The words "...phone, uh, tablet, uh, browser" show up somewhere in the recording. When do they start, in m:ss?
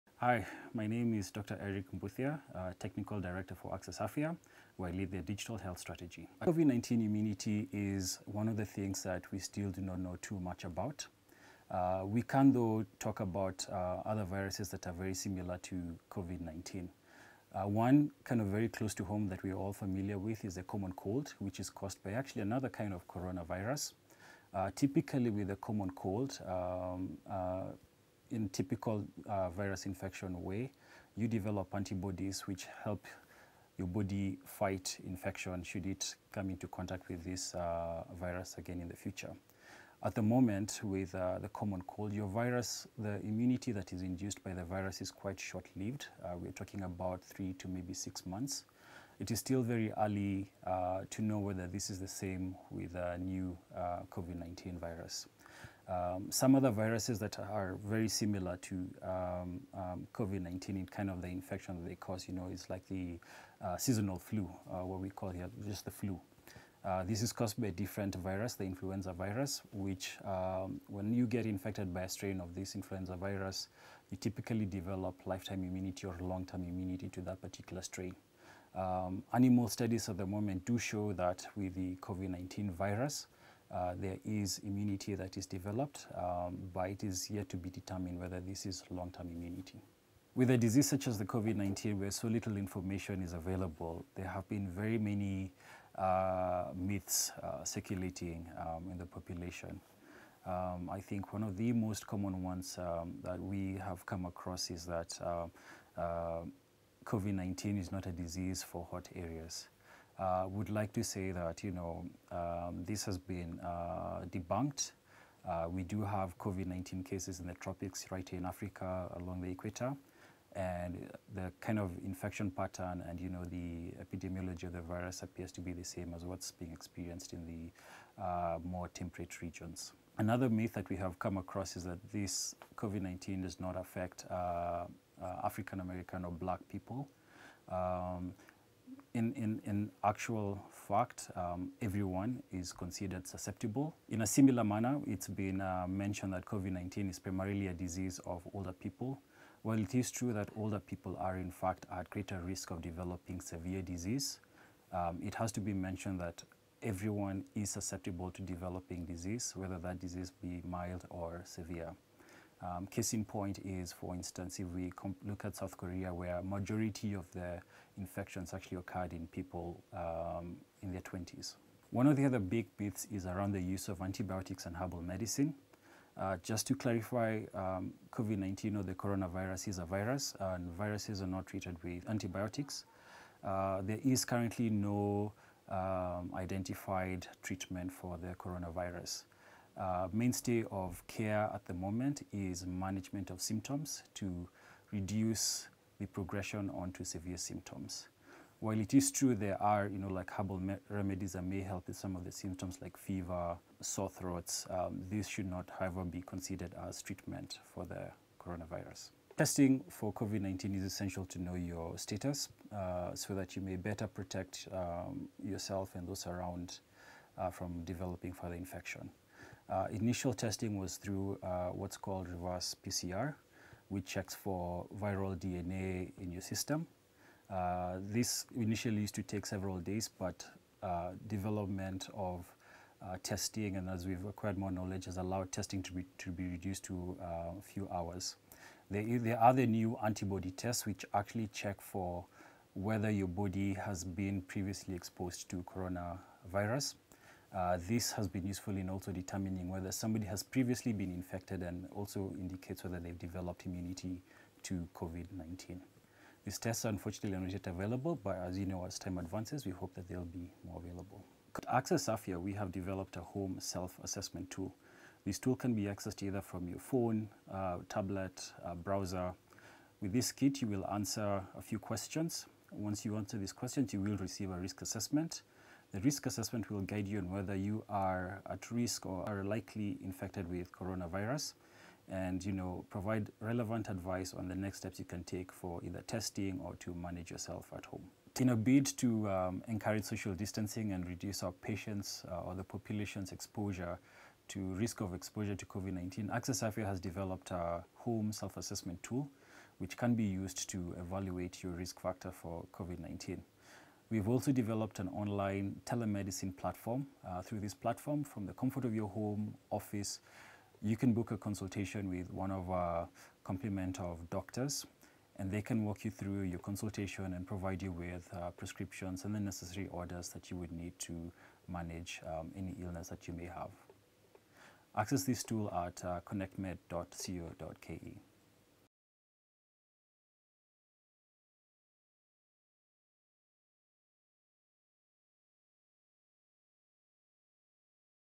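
4:26.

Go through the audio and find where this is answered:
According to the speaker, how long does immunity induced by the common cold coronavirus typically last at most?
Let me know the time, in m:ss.
0:47.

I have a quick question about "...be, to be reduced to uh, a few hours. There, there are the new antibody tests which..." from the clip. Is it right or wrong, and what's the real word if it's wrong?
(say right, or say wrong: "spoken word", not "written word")
right.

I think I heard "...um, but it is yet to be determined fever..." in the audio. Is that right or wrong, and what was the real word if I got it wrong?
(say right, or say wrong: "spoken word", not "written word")
wrong: "whether", not "fever".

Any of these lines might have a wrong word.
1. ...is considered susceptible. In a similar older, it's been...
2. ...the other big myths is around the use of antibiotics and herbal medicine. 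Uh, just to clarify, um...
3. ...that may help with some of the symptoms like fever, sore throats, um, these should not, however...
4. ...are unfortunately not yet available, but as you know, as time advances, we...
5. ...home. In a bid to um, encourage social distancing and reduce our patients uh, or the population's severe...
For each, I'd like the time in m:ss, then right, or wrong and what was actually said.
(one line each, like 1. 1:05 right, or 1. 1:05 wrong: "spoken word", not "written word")
1. 2:22 wrong: "manner", not "older"
2. 2:52 right
3. 3:21 right
4. 4:16 right
5. 4:47 wrong: "exposure", not "severe".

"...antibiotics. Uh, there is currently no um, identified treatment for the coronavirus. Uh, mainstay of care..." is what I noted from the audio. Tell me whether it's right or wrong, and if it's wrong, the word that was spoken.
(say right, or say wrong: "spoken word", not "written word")
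right.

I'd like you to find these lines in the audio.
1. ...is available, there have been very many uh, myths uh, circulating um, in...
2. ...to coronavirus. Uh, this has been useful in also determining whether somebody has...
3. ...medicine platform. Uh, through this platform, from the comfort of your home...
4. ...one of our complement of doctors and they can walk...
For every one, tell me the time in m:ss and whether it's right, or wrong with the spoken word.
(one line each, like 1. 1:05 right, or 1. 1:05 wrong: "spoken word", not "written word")
1. 1:33 right
2. 4:05 right
3. 5:05 wrong: "telemedicine", not "medicine"
4. 5:12 right.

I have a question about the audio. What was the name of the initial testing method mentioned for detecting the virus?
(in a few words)
reverse PCR.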